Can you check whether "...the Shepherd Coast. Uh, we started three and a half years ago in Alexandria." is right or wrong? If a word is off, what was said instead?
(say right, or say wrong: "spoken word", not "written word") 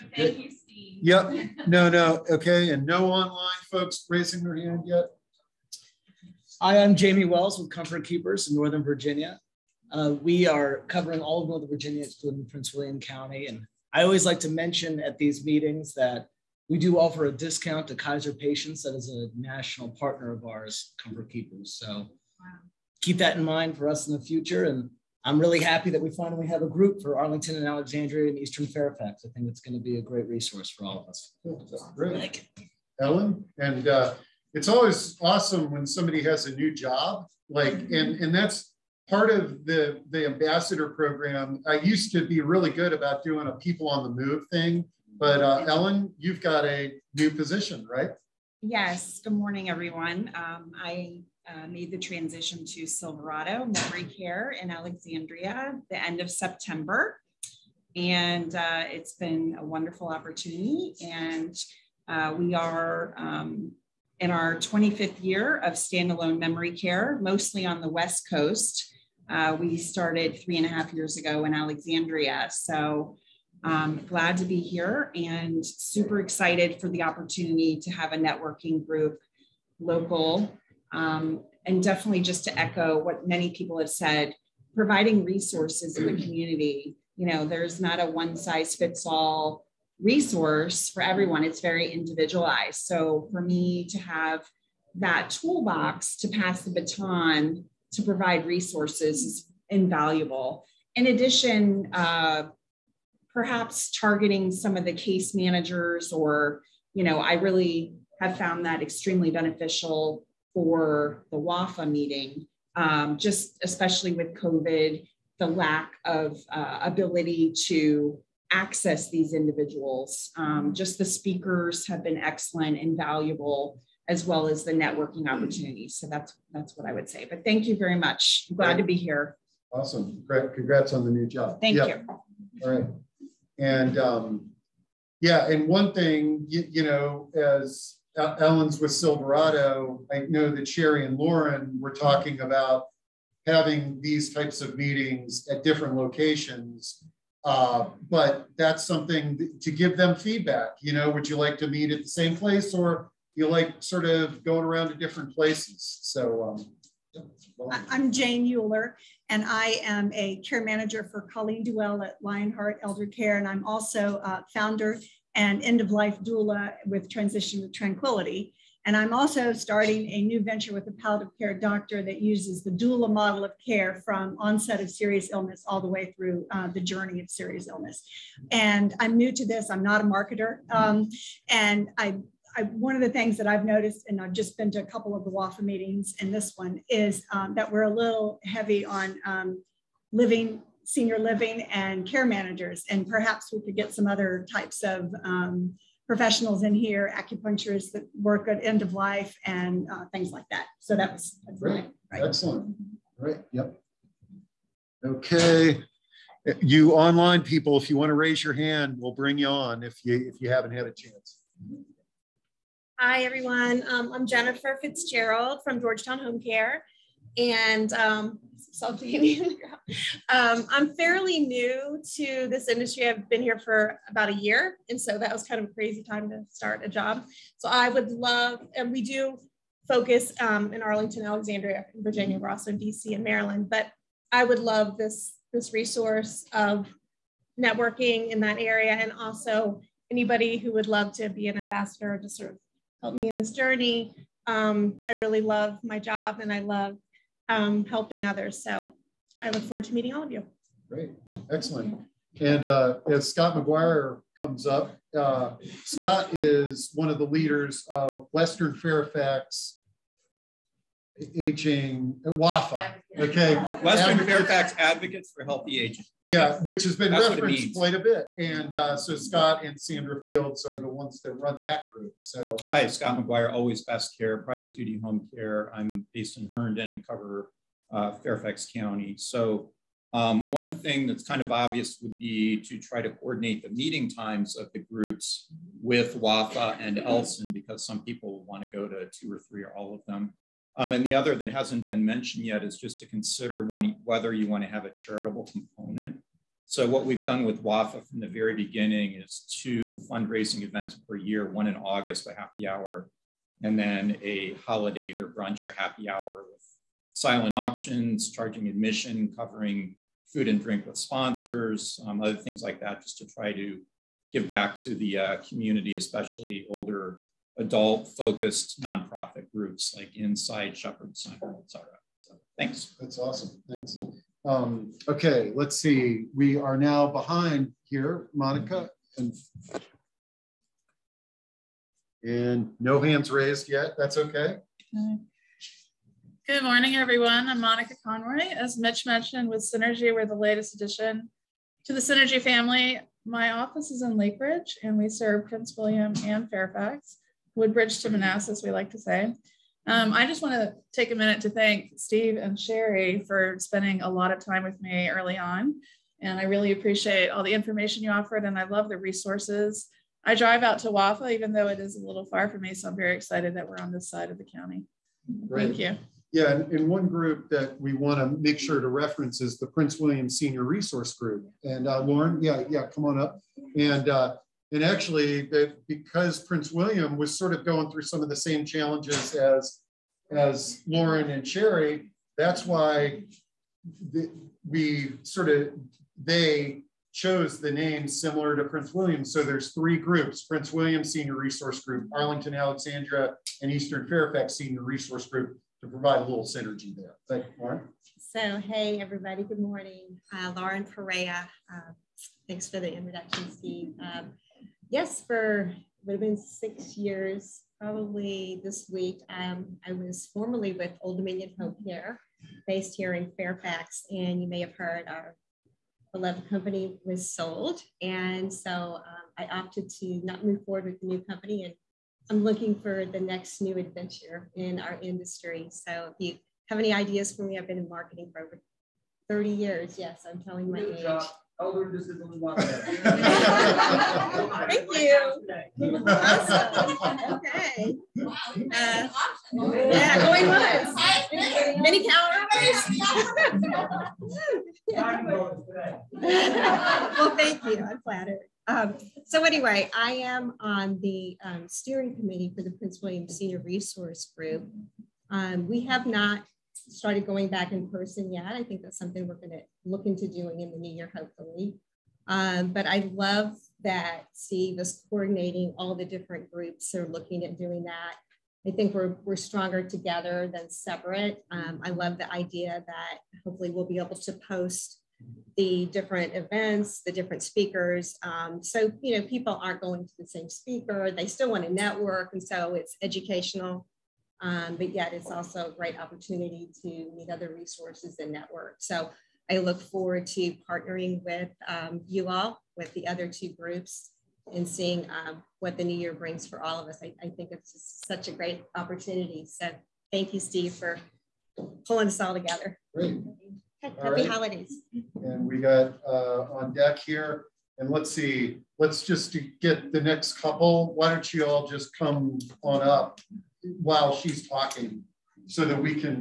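wrong: "West", not "Shepherd".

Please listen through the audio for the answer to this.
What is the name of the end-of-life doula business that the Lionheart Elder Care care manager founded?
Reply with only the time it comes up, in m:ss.
2:47.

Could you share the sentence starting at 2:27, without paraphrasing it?
Uh, but that's something th- to give them feedback.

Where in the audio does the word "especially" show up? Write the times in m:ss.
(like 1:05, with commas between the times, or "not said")
1:53, 5:15.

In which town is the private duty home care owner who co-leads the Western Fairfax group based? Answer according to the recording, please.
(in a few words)
Herndon.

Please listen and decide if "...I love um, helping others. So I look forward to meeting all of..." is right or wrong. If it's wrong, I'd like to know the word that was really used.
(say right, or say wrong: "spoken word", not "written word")
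right.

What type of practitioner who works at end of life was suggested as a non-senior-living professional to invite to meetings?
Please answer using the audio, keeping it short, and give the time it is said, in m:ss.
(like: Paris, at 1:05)
Acupuncturists, at 3:17.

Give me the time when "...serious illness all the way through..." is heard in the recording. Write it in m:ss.
2:54.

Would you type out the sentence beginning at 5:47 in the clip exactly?
Woodbridge to Manassas, we like to say.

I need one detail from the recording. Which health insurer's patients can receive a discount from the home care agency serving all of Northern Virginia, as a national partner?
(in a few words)
Kaiser.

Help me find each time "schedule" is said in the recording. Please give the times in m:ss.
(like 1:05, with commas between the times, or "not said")
not said.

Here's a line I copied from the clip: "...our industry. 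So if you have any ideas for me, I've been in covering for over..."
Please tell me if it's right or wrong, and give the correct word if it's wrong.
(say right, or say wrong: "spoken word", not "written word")
wrong: "marketing", not "covering".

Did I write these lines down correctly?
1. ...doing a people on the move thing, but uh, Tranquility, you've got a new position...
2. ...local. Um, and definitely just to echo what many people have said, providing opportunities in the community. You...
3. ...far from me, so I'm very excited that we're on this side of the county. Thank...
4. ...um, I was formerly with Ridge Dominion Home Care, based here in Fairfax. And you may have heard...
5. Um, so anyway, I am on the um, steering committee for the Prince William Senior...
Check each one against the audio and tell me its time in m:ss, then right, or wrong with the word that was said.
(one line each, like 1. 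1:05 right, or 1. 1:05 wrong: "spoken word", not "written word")
1. 0:43 wrong: "Ellen", not "Tranquility"
2. 1:19 wrong: "resources", not "opportunities"
3. 6:02 right
4. 6:49 wrong: "Old", not "Ridge"
5. 7:28 right.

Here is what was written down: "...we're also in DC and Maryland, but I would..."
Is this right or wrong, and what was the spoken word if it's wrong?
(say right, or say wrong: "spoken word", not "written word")
right.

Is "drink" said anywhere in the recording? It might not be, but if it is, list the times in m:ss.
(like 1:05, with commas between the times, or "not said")
5:10.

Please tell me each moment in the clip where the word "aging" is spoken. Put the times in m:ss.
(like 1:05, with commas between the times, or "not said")
4:21, 4:25.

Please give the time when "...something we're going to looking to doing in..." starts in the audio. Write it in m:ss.
7:38.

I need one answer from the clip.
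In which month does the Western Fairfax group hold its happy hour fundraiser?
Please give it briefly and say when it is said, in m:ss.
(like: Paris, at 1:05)
August, at 5:01.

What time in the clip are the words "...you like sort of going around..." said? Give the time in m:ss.
2:33.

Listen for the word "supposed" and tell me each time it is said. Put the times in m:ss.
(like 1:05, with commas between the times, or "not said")
not said.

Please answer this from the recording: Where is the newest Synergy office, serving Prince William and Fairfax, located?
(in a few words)
Lake Ridge.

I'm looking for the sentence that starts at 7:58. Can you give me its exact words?
Um, so, you know, people aren't going to the same speaker.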